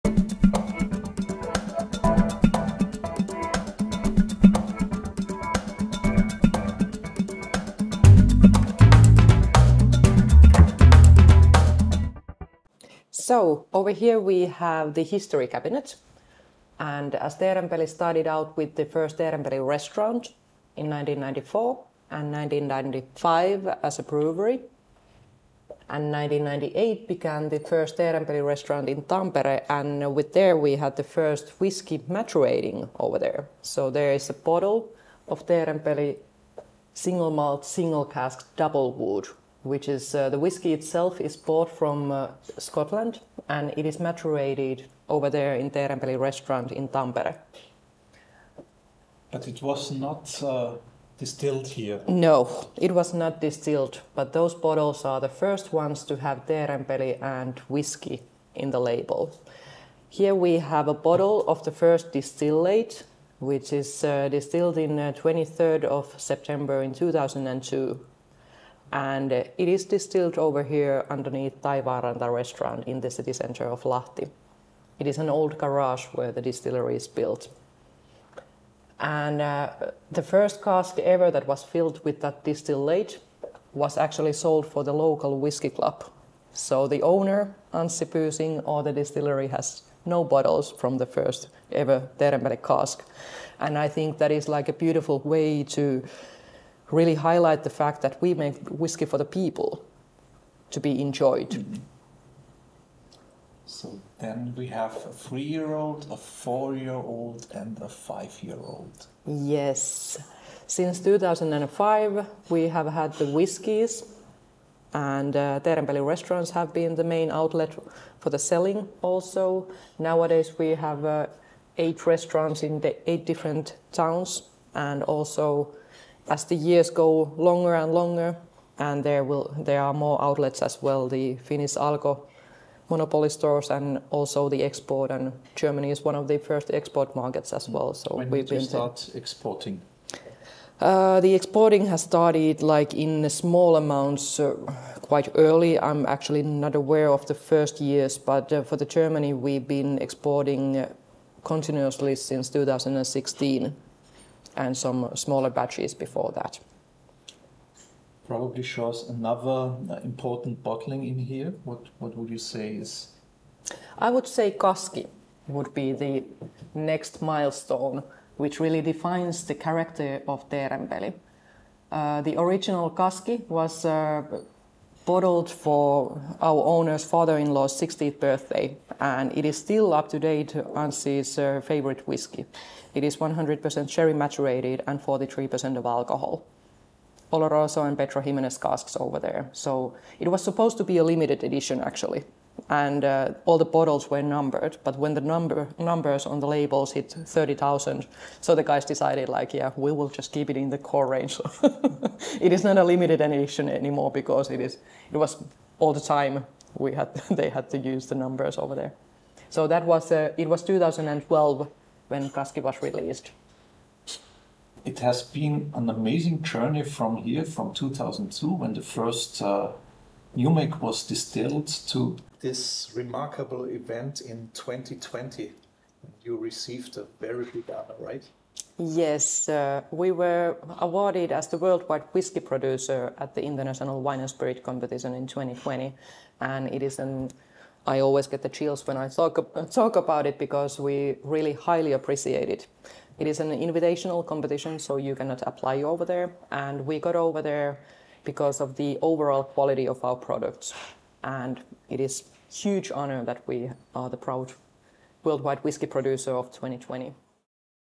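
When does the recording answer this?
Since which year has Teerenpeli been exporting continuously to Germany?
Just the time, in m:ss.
2:32.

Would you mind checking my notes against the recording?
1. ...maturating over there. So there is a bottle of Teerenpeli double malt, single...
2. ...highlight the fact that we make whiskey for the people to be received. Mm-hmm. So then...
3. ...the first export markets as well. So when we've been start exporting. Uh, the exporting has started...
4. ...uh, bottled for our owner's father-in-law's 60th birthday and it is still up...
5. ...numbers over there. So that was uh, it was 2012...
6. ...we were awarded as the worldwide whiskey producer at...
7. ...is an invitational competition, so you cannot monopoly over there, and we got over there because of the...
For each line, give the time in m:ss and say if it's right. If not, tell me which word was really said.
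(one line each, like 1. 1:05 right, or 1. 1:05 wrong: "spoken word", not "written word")
1. 0:31 wrong: "single", not "double"
2. 1:37 wrong: "enjoyed", not "received"
3. 2:16 right
4. 2:53 right
5. 3:28 right
6. 3:49 right
7. 4:03 wrong: "apply", not "monopoly".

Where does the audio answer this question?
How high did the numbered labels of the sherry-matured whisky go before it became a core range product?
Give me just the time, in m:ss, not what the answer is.
3:17.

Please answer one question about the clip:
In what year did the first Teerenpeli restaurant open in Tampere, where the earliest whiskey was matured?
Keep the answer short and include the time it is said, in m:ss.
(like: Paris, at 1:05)
1998, at 0:26.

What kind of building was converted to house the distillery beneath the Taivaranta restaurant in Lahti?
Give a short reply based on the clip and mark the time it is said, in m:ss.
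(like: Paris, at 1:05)
An old garage, at 1:15.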